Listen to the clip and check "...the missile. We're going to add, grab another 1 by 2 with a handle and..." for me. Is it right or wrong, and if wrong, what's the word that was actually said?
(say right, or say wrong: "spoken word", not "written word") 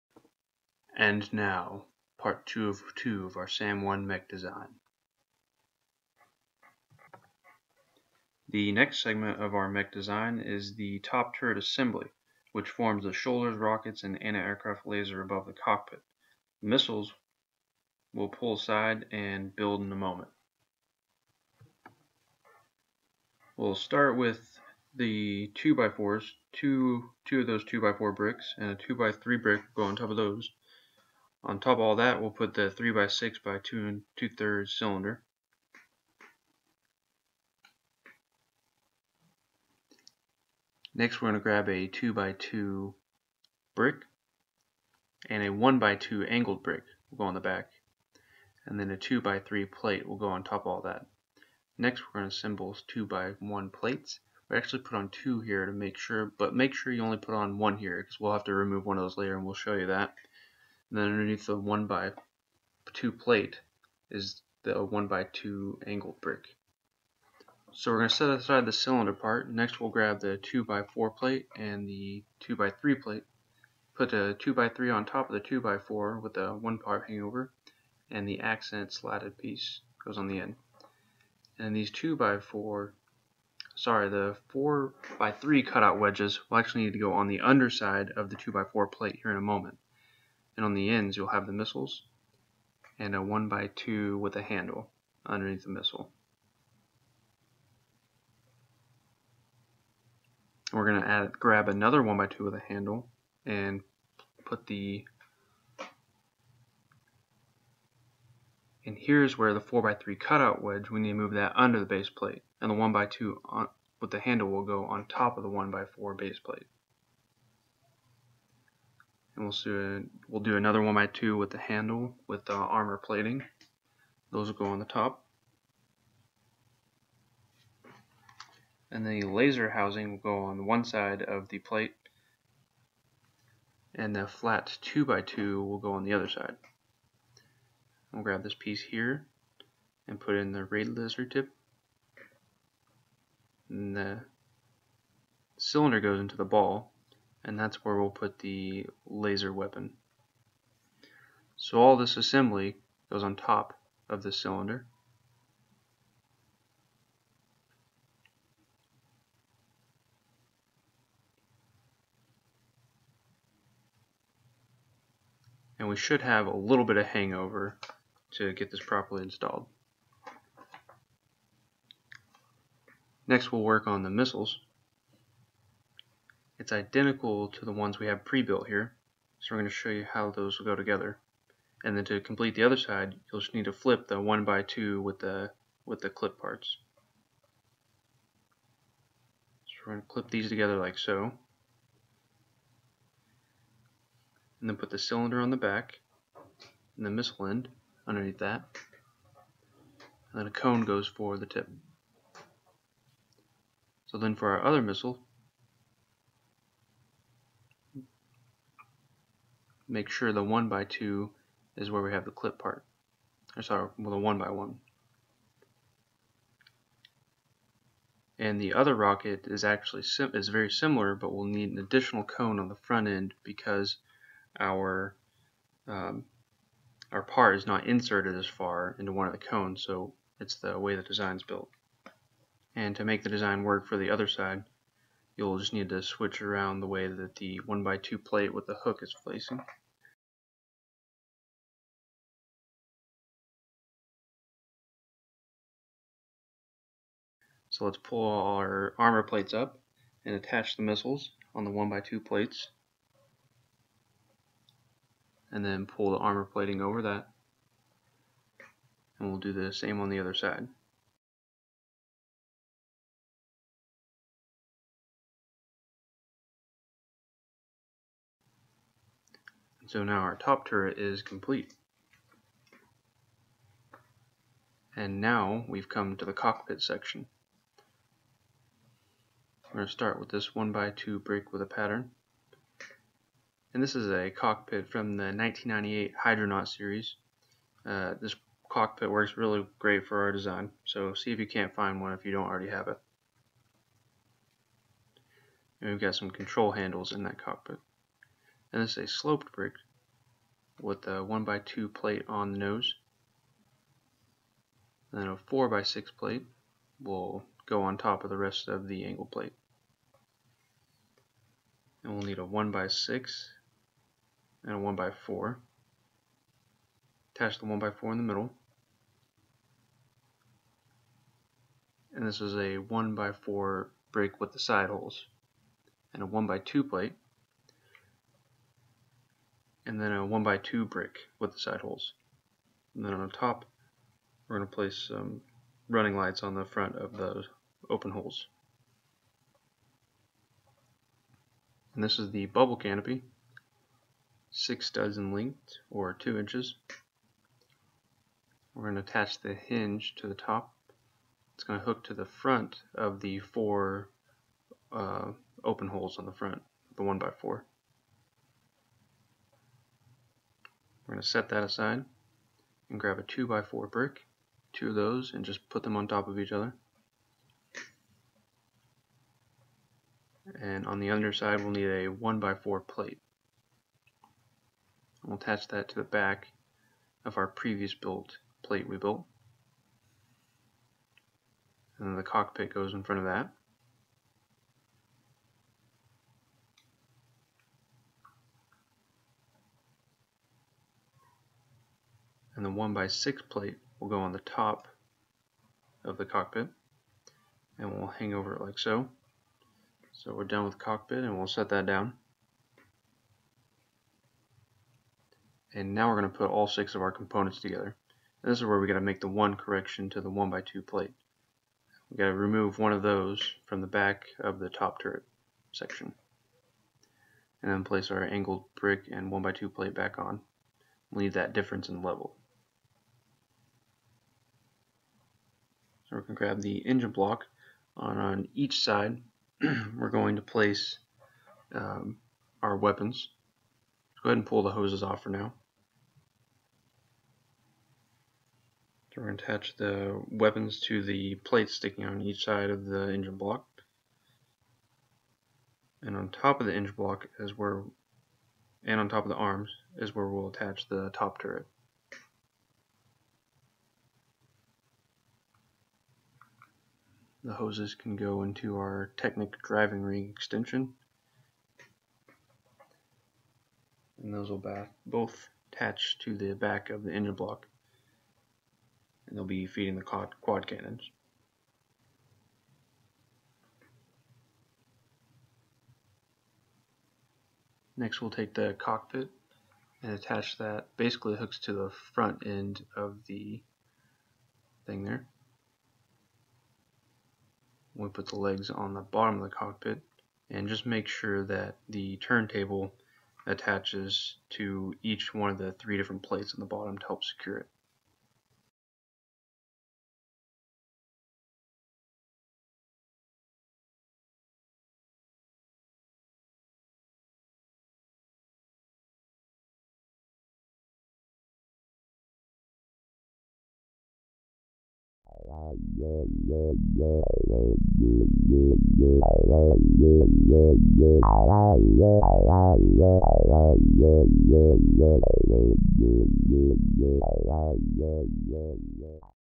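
right.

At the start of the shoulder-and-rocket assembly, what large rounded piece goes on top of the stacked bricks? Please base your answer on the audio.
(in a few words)
3x6 by 2 and 2/3 cylinder.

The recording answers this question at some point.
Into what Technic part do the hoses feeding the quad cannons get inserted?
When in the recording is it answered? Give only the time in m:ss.
7:39.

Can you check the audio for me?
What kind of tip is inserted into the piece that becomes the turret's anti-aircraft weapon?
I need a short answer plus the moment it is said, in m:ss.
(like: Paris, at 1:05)
raid laser tip, at 2:20.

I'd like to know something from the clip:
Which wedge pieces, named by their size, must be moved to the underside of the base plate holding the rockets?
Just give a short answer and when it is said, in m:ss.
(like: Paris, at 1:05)
4 by 3 cutout wedges, at 1:24.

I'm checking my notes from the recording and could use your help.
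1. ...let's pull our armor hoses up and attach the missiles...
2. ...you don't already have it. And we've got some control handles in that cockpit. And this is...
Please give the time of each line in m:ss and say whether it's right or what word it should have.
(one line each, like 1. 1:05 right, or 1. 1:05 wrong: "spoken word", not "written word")
1. 4:07 wrong: "plates", not "hoses"
2. 4:52 right.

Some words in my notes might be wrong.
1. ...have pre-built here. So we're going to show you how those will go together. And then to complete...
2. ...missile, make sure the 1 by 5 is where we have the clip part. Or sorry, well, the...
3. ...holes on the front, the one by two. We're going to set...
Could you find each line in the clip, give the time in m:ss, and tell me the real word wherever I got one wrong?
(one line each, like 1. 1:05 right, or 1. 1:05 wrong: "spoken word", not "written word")
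1. 2:58 right
2. 3:24 wrong: "2", not "5"
3. 5:55 wrong: "four", not "two".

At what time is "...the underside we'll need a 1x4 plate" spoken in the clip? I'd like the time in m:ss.
6:10.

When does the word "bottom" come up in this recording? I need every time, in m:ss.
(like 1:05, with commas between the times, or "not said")
8:09, 8:16.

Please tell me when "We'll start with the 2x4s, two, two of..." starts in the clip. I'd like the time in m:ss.
0:23.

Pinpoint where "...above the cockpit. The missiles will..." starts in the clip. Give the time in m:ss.
0:15.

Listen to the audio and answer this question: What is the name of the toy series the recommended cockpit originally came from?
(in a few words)
Hydronaut.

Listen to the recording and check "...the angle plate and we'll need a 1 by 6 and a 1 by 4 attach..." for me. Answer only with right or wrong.
right.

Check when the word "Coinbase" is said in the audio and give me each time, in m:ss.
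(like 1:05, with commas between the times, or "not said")
not said.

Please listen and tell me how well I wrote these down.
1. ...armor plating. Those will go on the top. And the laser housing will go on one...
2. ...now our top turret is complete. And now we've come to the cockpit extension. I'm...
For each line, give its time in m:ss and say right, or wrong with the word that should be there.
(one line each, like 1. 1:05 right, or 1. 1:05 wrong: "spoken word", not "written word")
1. 2:02 right
2. 4:30 wrong: "section", not "extension".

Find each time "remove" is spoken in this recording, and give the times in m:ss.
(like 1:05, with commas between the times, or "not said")
0:58, 6:52.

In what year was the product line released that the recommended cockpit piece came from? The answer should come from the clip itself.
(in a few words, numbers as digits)
1998.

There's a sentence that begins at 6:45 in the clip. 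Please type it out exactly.
And now we're going to put all six of our components together.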